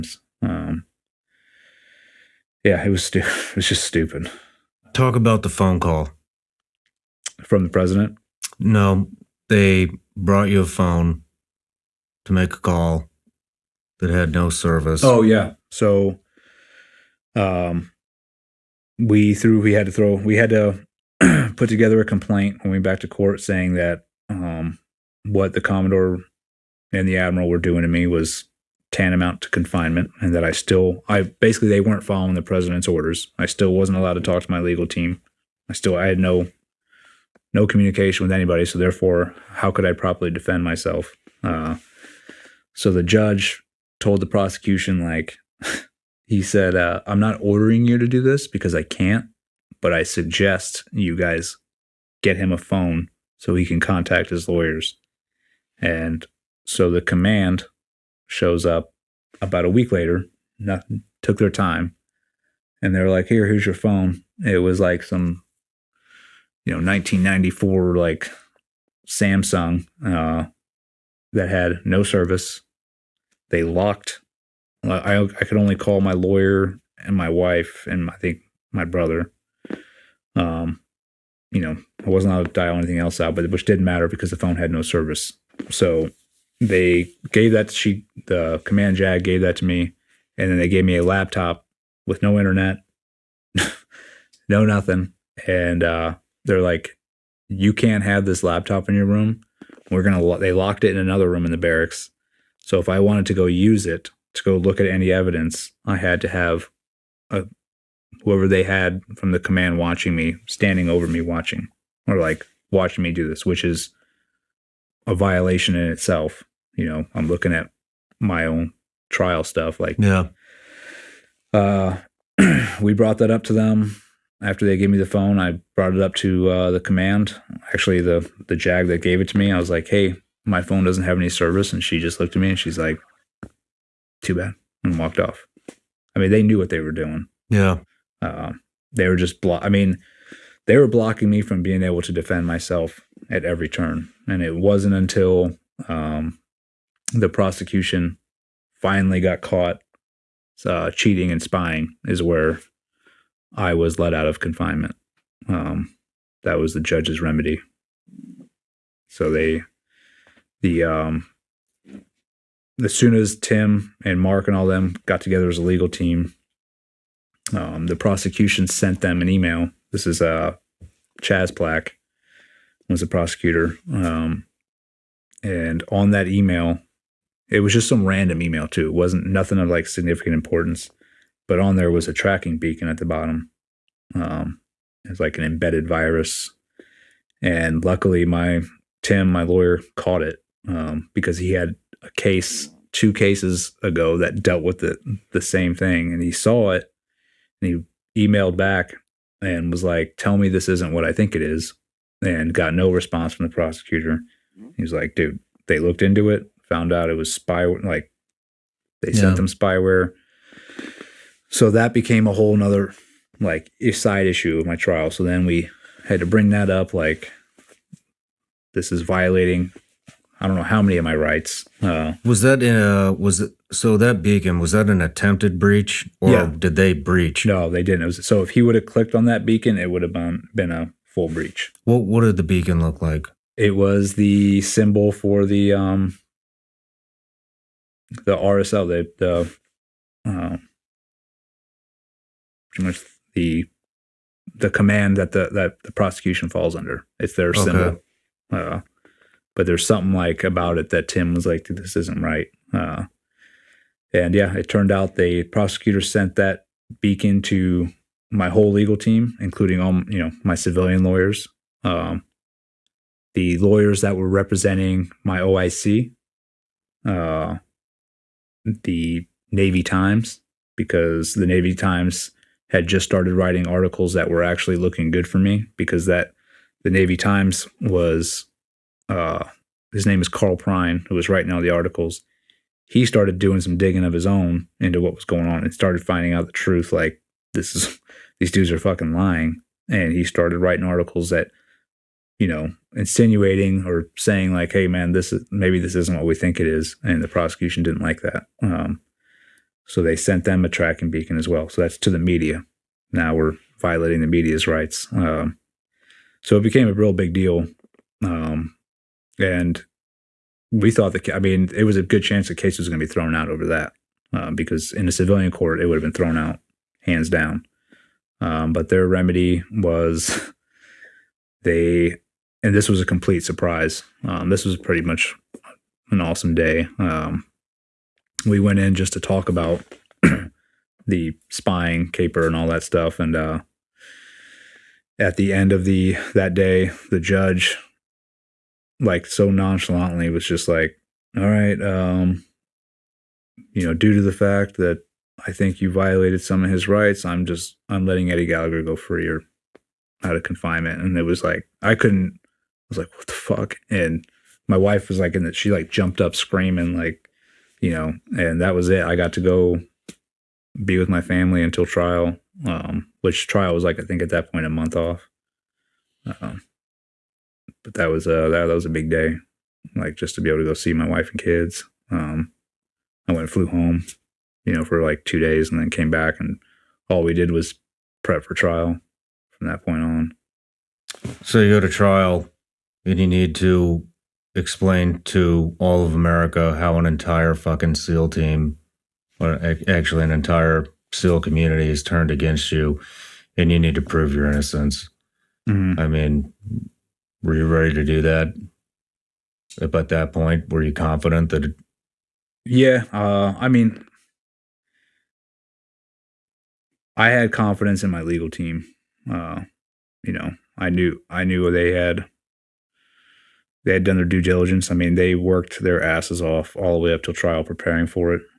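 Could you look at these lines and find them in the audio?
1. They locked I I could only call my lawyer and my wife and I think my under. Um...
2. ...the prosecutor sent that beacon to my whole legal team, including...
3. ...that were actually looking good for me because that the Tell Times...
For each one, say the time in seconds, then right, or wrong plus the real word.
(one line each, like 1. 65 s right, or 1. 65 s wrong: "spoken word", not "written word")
1. 73 s wrong: "brother", not "under"
2. 255 s right
3. 274 s wrong: "Navy", not "Tell".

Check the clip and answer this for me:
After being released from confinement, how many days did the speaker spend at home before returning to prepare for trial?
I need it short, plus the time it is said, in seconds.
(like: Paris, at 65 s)
2 days, at 375 s.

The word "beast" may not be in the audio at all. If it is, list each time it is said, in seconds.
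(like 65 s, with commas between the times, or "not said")
not said.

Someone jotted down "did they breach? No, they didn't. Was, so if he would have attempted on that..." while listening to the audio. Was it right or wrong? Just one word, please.
wrong.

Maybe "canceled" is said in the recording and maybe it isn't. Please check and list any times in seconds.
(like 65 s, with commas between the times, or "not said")
not said.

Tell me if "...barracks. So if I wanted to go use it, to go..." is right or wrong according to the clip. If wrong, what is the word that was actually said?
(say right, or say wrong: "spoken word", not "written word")
right.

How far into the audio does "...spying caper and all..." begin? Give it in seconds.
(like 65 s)
331 s.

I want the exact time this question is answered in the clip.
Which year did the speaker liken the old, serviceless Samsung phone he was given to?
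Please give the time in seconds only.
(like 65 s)
66 s.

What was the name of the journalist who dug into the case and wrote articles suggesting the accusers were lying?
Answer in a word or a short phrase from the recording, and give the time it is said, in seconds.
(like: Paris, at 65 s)
Carl Prine, at 280 s.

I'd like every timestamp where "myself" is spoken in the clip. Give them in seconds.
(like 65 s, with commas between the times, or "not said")
40 s, 142 s.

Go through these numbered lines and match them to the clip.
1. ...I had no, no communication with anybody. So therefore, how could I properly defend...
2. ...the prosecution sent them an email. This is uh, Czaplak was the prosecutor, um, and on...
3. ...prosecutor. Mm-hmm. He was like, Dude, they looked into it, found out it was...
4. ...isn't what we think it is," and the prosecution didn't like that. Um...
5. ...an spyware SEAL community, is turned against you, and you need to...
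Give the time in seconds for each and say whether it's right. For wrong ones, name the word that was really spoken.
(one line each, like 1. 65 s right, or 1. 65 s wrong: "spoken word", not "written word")
1. 35 s right
2. 167 s right
3. 203 s right
4. 295 s right
5. 390 s wrong: "entire", not "spyware".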